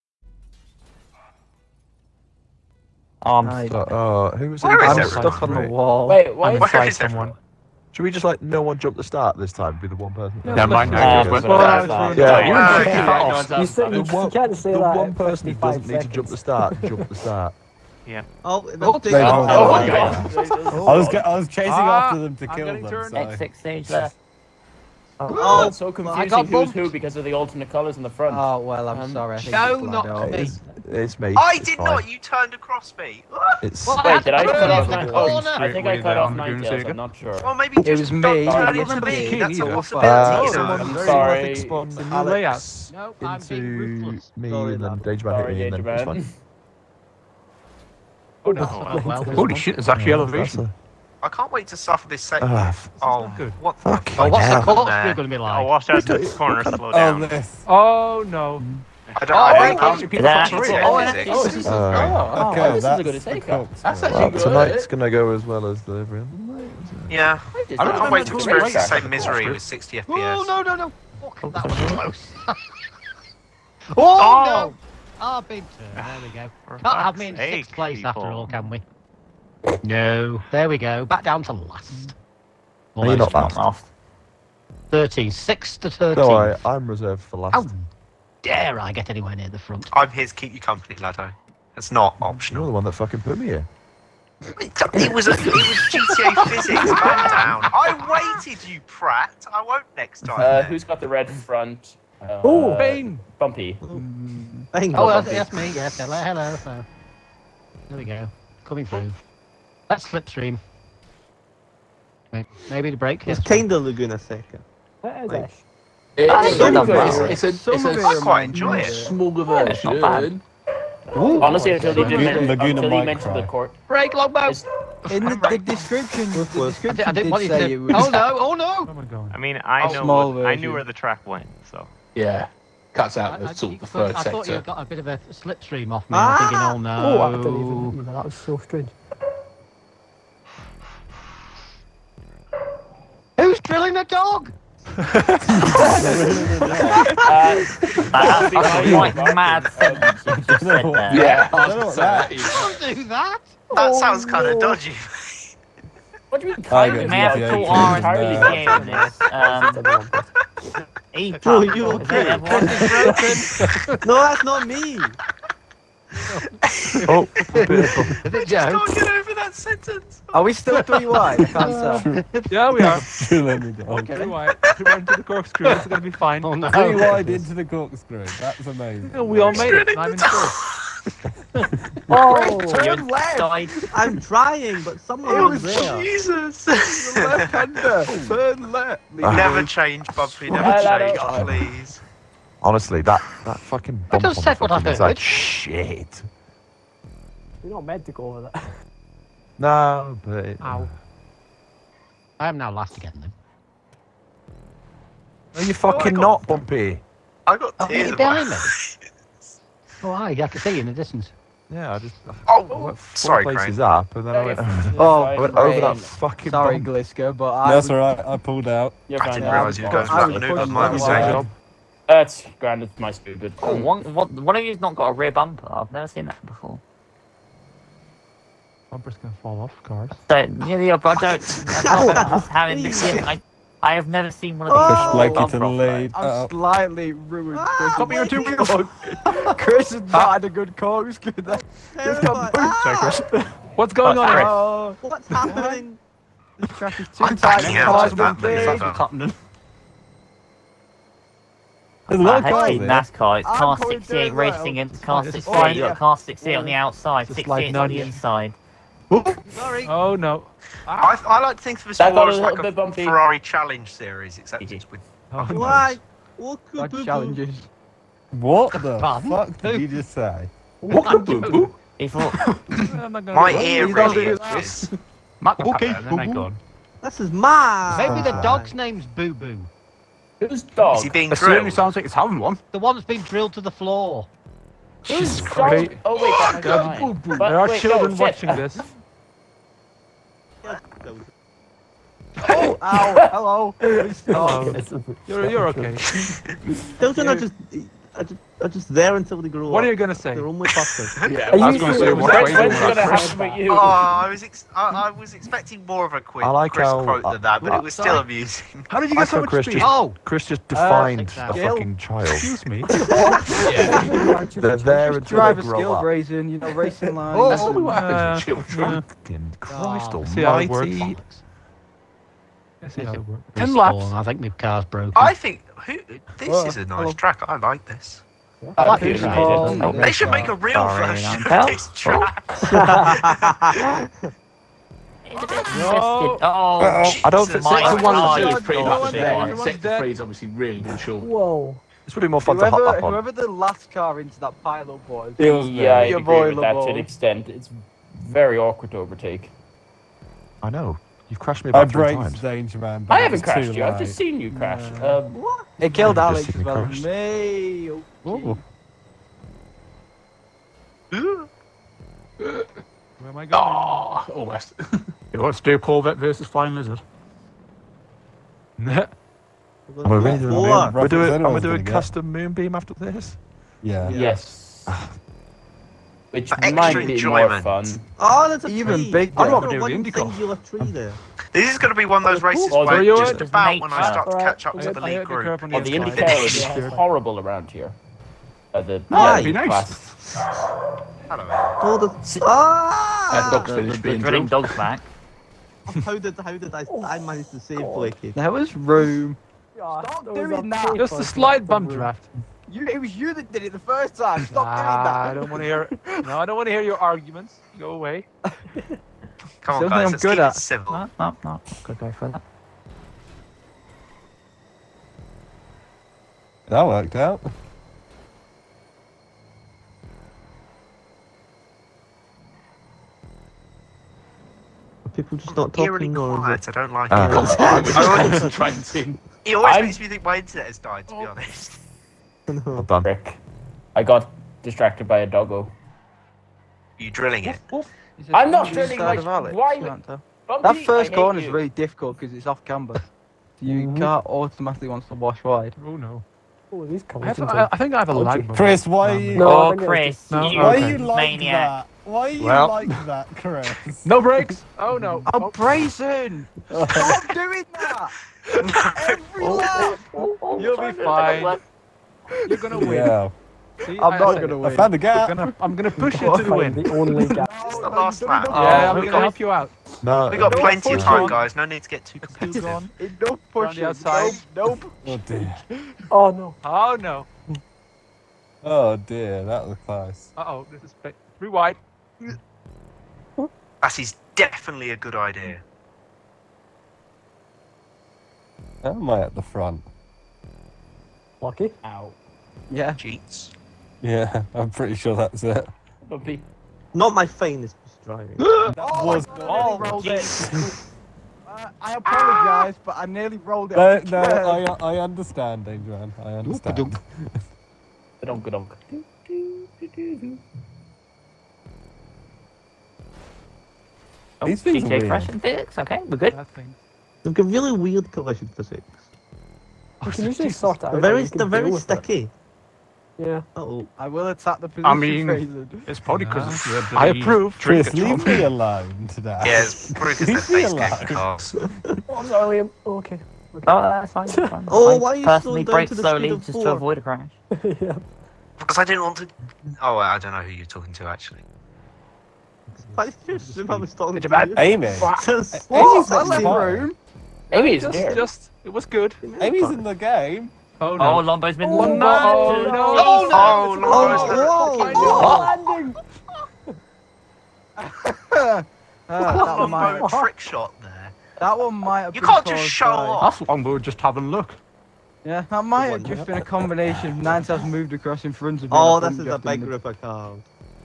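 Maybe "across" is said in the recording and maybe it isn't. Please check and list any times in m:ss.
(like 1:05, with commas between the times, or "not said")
0:32, 9:27.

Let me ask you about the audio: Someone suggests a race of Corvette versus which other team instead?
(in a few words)
Flying Lizard.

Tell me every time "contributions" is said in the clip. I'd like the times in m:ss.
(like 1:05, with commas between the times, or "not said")
not said.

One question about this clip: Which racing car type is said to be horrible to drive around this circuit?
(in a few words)
IndyCar.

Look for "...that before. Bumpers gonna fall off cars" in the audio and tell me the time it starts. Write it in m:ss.
3:46.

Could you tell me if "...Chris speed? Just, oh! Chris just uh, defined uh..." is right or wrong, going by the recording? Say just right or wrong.
right.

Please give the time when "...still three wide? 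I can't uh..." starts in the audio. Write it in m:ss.
2:50.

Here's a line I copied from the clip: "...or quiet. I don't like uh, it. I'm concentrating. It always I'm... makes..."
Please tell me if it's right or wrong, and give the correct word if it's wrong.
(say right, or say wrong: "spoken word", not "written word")
right.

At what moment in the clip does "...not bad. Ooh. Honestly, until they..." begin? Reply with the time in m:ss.
1:59.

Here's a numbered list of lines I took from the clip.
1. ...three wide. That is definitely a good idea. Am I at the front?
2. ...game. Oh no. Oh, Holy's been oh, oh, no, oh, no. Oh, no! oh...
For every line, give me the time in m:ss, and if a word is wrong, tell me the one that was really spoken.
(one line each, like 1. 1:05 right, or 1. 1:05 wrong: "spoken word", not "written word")
1. 8:01 right
2. 9:09 wrong: "Lombo", not "Holy".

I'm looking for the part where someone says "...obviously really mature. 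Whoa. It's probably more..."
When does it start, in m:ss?
5:40.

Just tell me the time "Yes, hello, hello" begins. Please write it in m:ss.
1:45.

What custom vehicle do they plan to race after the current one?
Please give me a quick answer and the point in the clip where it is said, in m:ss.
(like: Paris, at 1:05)
Moonbeam, at 6:12.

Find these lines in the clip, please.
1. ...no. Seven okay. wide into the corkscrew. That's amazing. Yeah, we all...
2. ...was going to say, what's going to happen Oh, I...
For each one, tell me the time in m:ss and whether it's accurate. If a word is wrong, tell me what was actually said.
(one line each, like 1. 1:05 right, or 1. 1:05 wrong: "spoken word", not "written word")
1. 2:56 wrong: "Three", not "Seven"
2. 5:01 right.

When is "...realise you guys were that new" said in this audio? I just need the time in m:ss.
3:39.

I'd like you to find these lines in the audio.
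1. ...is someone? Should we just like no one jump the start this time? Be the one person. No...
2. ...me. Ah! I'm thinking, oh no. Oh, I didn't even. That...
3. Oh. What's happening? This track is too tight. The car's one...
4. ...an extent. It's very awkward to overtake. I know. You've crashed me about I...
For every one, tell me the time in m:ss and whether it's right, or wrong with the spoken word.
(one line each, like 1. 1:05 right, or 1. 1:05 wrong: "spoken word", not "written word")
1. 0:06 right
2. 2:16 right
3. 4:04 right
4. 5:46 right.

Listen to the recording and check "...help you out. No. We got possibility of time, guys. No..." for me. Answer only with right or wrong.
wrong.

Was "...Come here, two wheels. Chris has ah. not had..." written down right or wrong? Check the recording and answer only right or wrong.
right.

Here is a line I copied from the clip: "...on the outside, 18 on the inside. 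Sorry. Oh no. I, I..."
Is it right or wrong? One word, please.
wrong.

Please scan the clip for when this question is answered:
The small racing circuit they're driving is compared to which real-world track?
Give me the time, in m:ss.
1:53.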